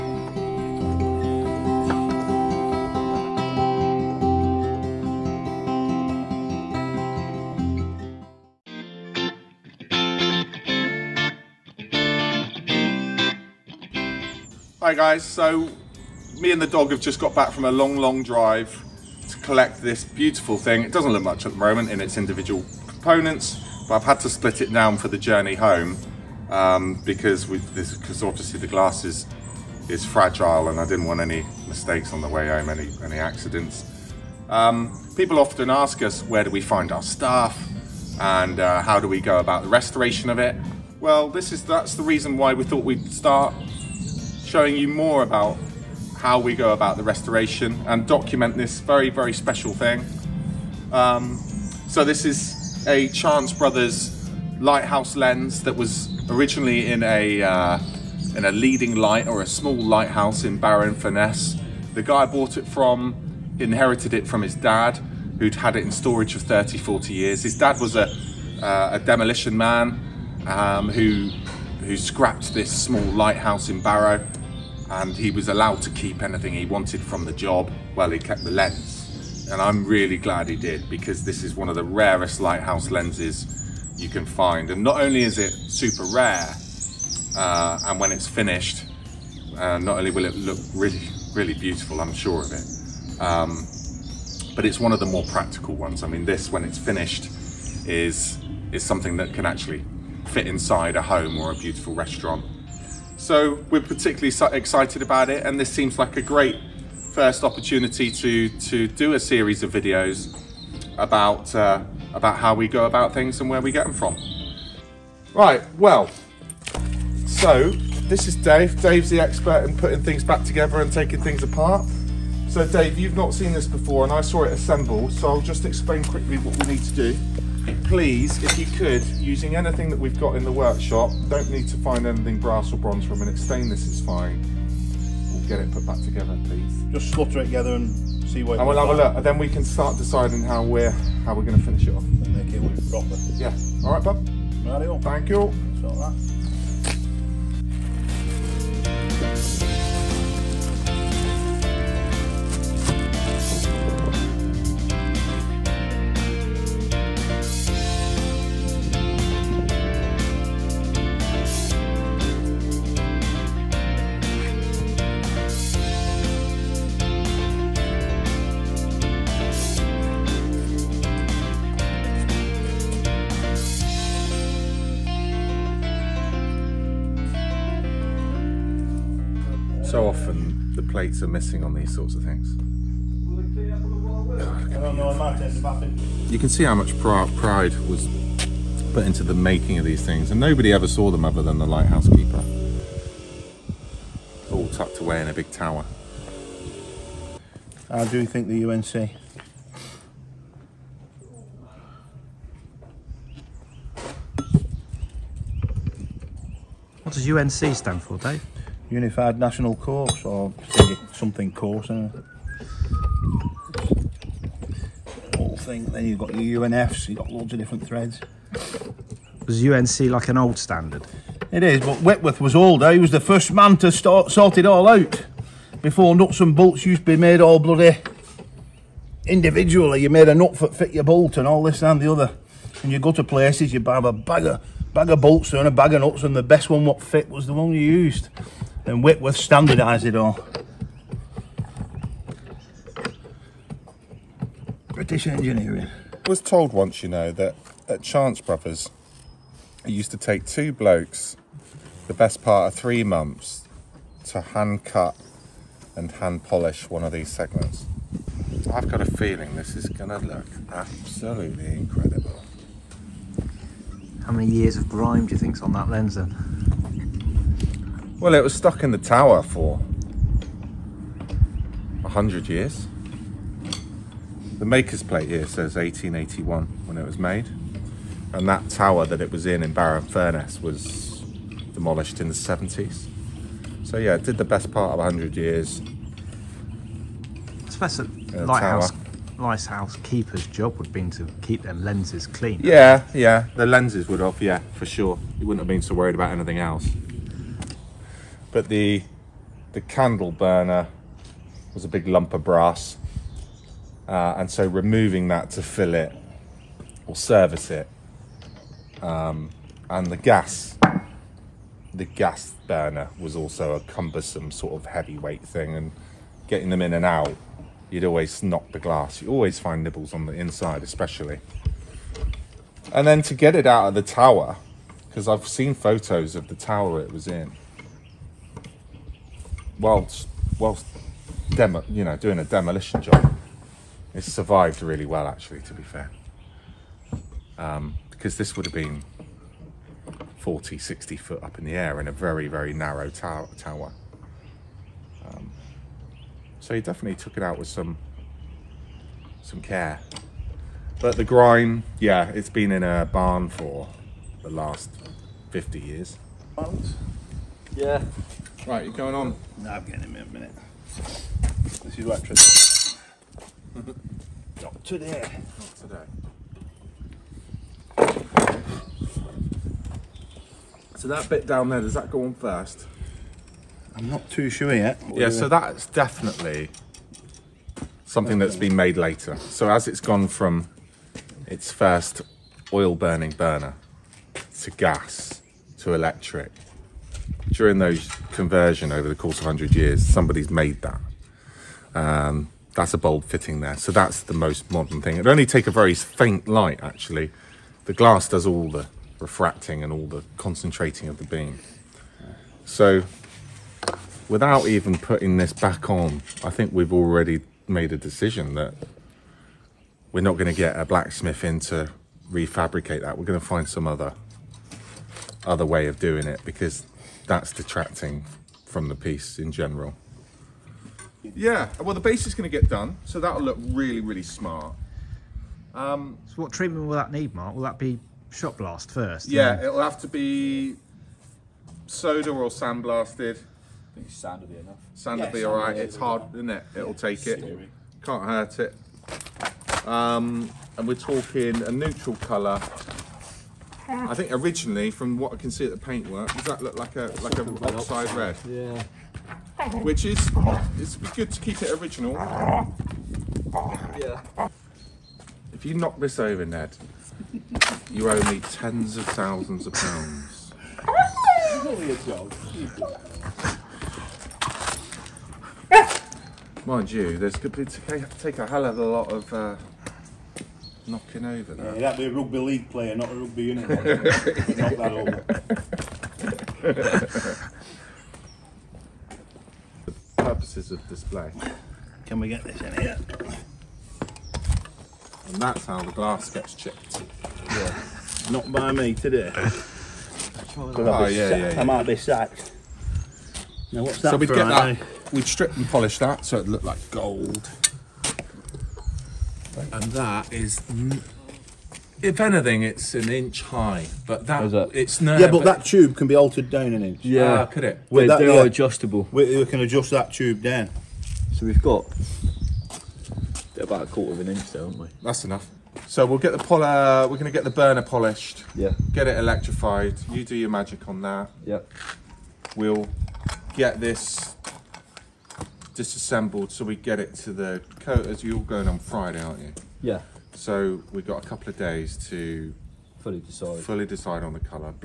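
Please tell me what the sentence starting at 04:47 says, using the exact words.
It's best that lighthouse, lighthouse keeper's job would have been to keep their lenses clean.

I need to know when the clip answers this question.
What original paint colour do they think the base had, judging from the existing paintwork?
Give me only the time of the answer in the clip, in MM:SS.
07:27.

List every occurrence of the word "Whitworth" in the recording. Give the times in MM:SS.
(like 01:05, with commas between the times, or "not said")
03:42, 03:59.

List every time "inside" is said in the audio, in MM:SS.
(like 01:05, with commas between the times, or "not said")
01:40, 05:20.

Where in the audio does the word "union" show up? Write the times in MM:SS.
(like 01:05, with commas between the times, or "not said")
07:53.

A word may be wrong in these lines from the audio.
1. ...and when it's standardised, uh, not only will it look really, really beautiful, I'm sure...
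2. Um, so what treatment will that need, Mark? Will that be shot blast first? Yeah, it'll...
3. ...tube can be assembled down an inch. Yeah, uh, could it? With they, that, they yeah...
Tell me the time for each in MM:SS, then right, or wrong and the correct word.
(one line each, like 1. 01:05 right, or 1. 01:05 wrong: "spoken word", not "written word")
1. 01:27 wrong: "finished", not "standardised"
2. 07:05 right
3. 08:25 wrong: "altered", not "assembled".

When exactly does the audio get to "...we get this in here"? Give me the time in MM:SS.
08:02.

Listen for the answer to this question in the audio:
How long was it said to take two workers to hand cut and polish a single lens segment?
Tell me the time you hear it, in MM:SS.
04:12.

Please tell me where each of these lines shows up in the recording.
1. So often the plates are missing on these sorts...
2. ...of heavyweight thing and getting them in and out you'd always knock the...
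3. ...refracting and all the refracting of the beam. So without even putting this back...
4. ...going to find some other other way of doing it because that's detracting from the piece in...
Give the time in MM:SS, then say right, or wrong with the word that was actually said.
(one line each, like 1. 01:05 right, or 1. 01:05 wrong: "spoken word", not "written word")
1. 02:59 right
2. 05:14 right
3. 06:39 wrong: "concentrating", not "refracting"
4. 06:53 right.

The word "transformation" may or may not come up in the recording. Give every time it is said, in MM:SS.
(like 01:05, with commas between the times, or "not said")
not said.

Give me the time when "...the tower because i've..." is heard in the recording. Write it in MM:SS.
05:23.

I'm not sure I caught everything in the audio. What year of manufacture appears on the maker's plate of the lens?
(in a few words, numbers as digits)
1881.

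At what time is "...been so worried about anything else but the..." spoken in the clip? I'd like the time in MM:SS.
04:55.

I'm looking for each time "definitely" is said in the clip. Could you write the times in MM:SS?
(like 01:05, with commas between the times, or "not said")
05:46, 06:15.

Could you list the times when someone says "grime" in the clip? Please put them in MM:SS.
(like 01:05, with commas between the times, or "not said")
04:24, 05:51.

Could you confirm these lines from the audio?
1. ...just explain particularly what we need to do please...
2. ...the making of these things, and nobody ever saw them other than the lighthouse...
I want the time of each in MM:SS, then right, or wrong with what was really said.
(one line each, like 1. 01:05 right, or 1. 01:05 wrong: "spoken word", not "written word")
1. 02:05 wrong: "quickly", not "particularly"
2. 03:09 right.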